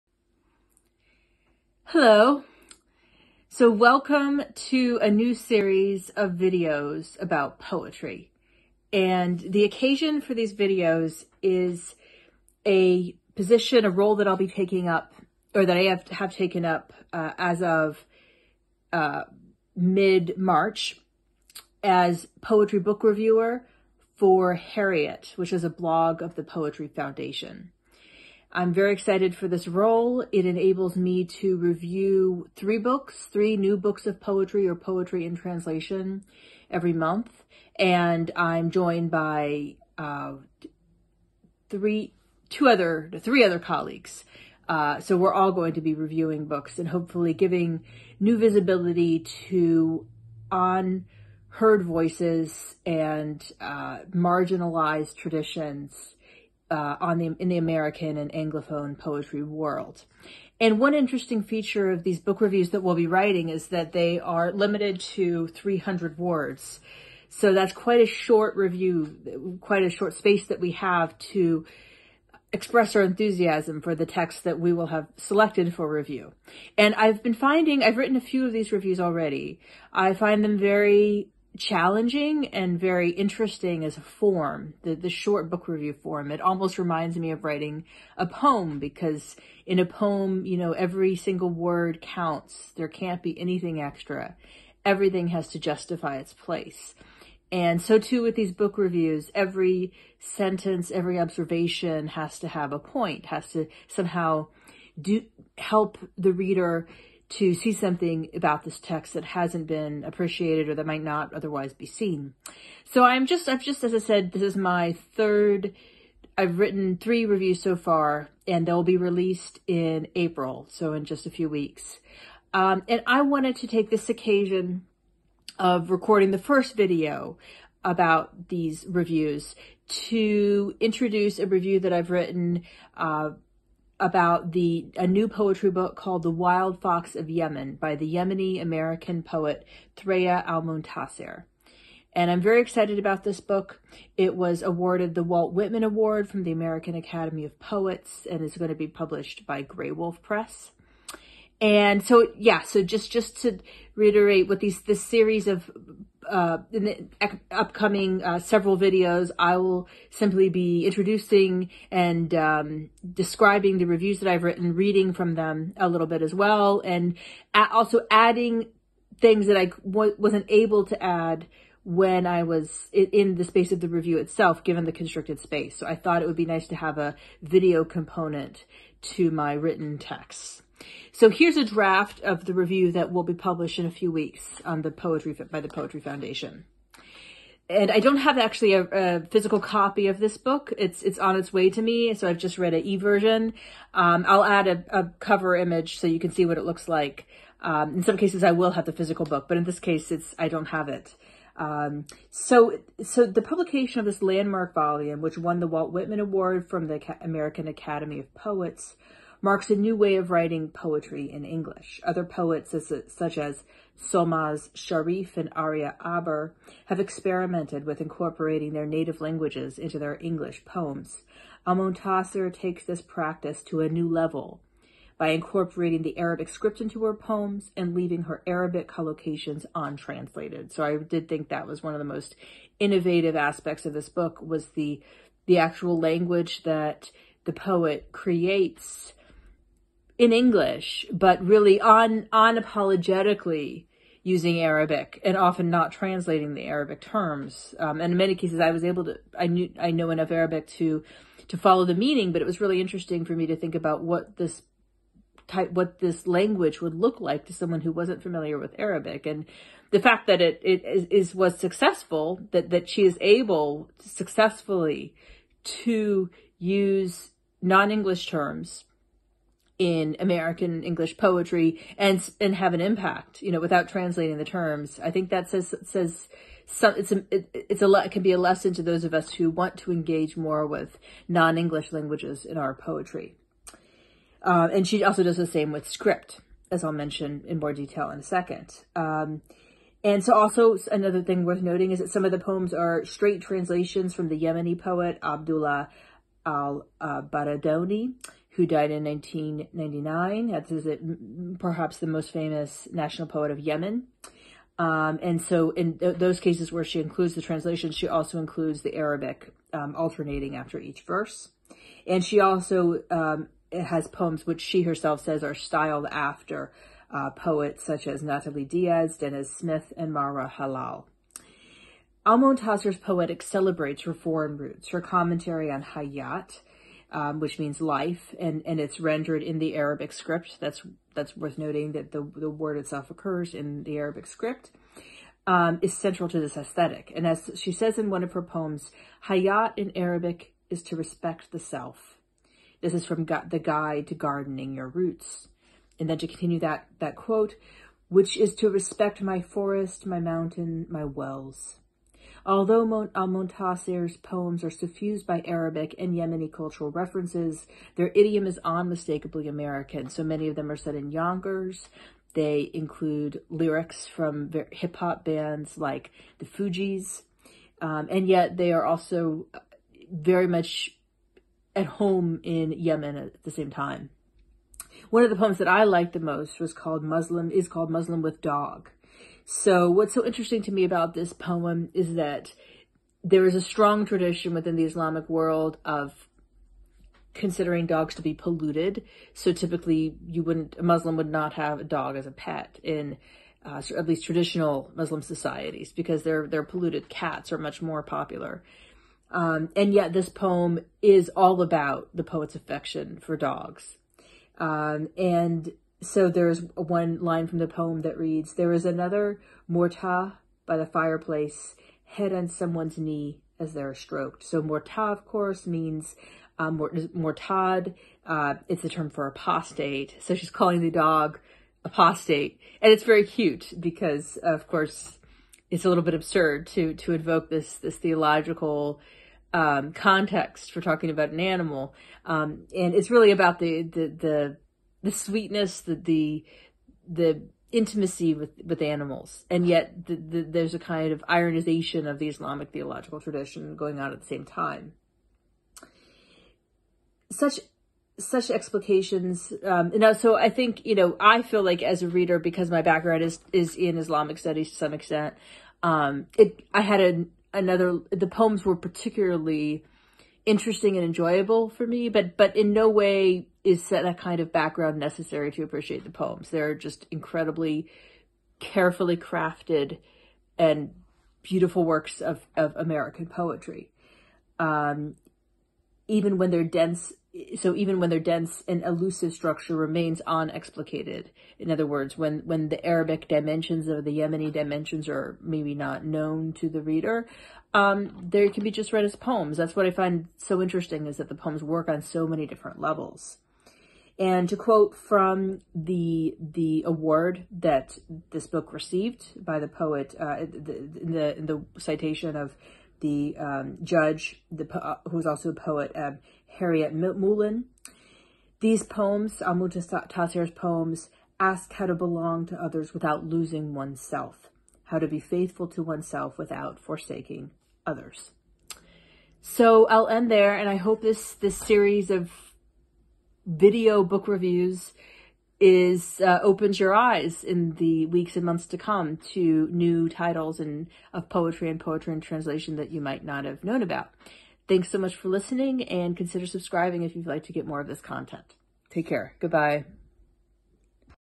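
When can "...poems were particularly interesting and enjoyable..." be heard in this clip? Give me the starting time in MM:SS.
07:38.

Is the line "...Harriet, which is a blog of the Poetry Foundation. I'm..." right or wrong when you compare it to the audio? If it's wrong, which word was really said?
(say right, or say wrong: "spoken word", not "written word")
right.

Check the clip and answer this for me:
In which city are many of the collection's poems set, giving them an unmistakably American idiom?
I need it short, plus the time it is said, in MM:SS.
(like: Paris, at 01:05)
Yonkers, at 06:01.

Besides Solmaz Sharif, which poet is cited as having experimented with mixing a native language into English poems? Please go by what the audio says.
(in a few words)
Aria Aber.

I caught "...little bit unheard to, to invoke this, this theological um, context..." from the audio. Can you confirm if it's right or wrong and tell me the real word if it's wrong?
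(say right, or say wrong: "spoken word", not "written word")
wrong: "absurd", not "unheard".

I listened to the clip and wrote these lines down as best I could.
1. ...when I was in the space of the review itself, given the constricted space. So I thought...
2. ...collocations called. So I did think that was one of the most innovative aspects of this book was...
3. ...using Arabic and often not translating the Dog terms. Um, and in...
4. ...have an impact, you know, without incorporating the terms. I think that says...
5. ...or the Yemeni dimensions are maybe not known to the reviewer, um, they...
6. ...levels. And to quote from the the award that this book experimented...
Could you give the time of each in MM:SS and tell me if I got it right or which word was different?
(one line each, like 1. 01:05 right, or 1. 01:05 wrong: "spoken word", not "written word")
1. 02:51 right
2. 03:48 wrong: "untranslated", not "called"
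3. 04:04 wrong: "Arabic", not "Dog"
4. 04:32 wrong: "translating", not "incorporating"
5. 08:03 wrong: "reader", not "reviewer"
6. 08:12 wrong: "received", not "experimented".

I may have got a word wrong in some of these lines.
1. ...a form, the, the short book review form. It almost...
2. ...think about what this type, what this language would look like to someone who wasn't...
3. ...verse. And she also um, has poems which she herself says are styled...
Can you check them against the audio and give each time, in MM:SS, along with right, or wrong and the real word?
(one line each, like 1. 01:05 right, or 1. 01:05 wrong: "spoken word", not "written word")
1. 01:23 right
2. 04:13 right
3. 05:11 right.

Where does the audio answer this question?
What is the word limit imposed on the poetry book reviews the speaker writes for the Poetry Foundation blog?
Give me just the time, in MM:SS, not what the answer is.
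01:05.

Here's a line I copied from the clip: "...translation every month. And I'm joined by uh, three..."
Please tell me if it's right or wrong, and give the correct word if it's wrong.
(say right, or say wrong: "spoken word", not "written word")
right.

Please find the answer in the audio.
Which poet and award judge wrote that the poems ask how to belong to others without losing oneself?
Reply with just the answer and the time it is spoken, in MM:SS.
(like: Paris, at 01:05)
Harryette Mullen, at 08:26.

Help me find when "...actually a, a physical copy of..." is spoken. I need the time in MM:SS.
03:08.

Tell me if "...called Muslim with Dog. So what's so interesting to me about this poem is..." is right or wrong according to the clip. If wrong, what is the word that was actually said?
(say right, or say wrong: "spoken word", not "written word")
right.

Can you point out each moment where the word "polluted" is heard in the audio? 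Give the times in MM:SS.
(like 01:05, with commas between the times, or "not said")
06:28, 06:36.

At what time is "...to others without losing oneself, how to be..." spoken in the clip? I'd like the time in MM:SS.
08:32.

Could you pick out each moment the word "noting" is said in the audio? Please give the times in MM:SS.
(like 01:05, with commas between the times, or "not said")
04:51, 05:31.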